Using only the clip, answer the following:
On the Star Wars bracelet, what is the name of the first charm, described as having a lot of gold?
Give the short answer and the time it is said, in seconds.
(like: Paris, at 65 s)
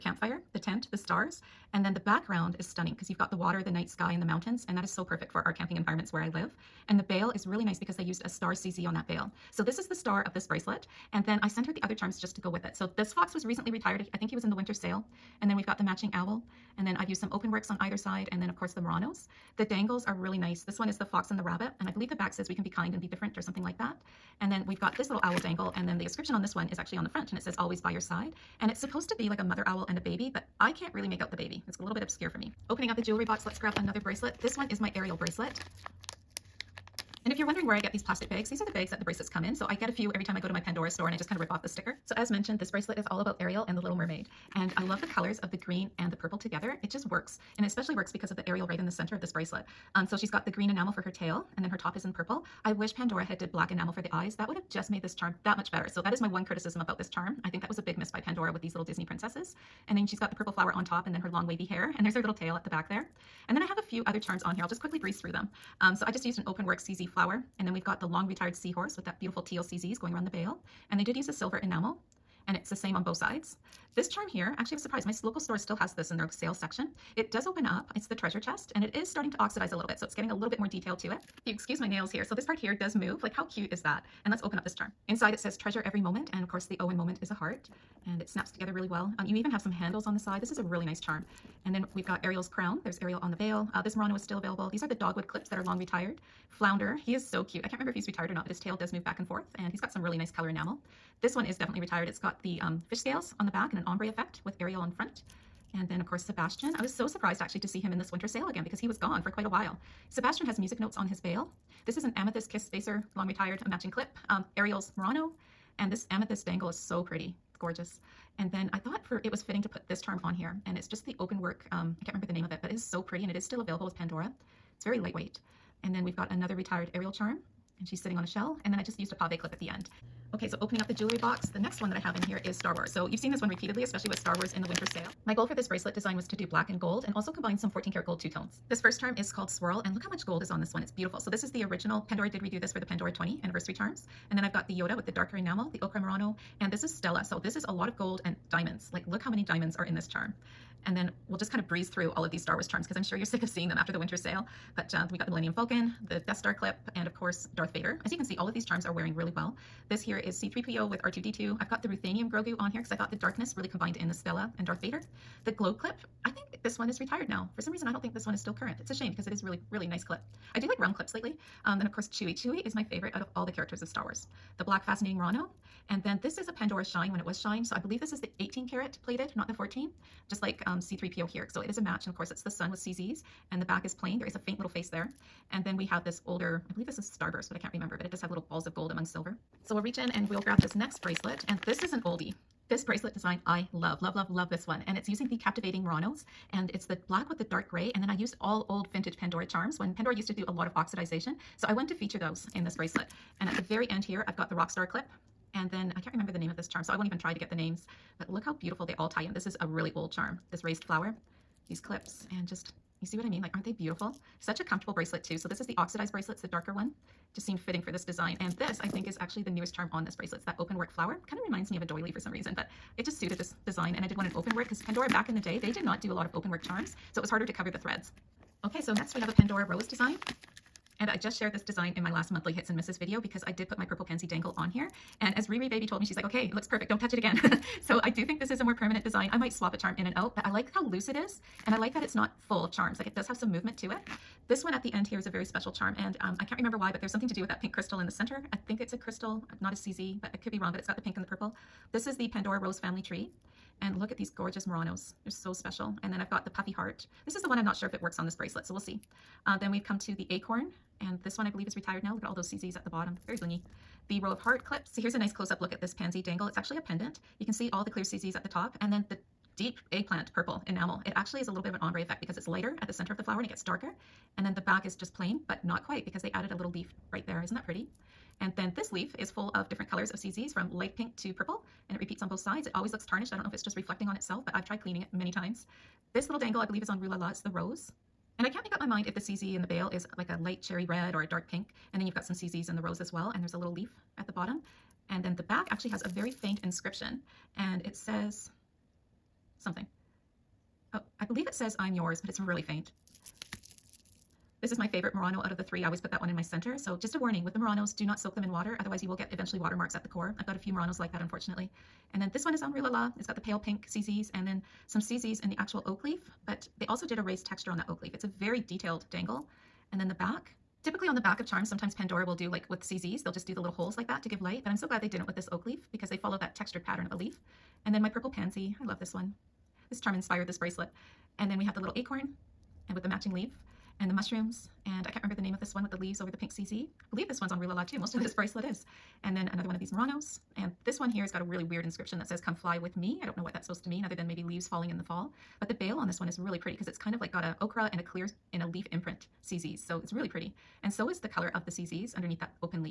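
Swirl, at 139 s.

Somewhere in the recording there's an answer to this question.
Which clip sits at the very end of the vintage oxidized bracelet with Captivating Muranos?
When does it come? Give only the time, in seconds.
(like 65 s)
204 s.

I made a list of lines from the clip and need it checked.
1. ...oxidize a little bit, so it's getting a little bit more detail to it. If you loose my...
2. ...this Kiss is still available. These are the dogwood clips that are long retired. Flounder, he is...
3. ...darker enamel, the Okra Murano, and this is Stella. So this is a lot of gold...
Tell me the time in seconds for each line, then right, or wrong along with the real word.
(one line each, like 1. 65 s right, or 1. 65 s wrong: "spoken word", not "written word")
1. 79 s wrong: "excuse", not "loose"
2. 93 s wrong: "Murano", not "Kiss"
3. 145 s right.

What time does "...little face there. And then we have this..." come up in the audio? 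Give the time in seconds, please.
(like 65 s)
184 s.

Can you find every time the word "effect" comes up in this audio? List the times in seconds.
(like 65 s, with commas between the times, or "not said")
104 s, 272 s.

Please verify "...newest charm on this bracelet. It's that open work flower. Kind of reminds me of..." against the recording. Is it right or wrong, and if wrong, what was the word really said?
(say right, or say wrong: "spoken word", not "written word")
right.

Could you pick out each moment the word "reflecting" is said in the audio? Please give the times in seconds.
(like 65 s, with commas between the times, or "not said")
283 s.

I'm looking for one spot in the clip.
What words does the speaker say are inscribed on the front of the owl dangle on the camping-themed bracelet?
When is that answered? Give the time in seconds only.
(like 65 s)
27 s.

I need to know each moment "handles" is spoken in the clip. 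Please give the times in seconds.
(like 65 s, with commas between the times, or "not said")
89 s.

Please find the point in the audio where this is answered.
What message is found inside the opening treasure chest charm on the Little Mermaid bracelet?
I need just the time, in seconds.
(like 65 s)
85 s.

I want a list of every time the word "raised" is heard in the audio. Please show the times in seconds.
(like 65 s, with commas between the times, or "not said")
210 s, 317 s.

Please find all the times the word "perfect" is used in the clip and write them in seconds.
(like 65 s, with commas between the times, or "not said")
5 s, 236 s.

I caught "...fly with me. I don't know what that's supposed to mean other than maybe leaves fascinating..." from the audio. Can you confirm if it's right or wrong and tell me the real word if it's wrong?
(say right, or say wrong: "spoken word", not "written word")
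wrong: "falling", not "fascinating".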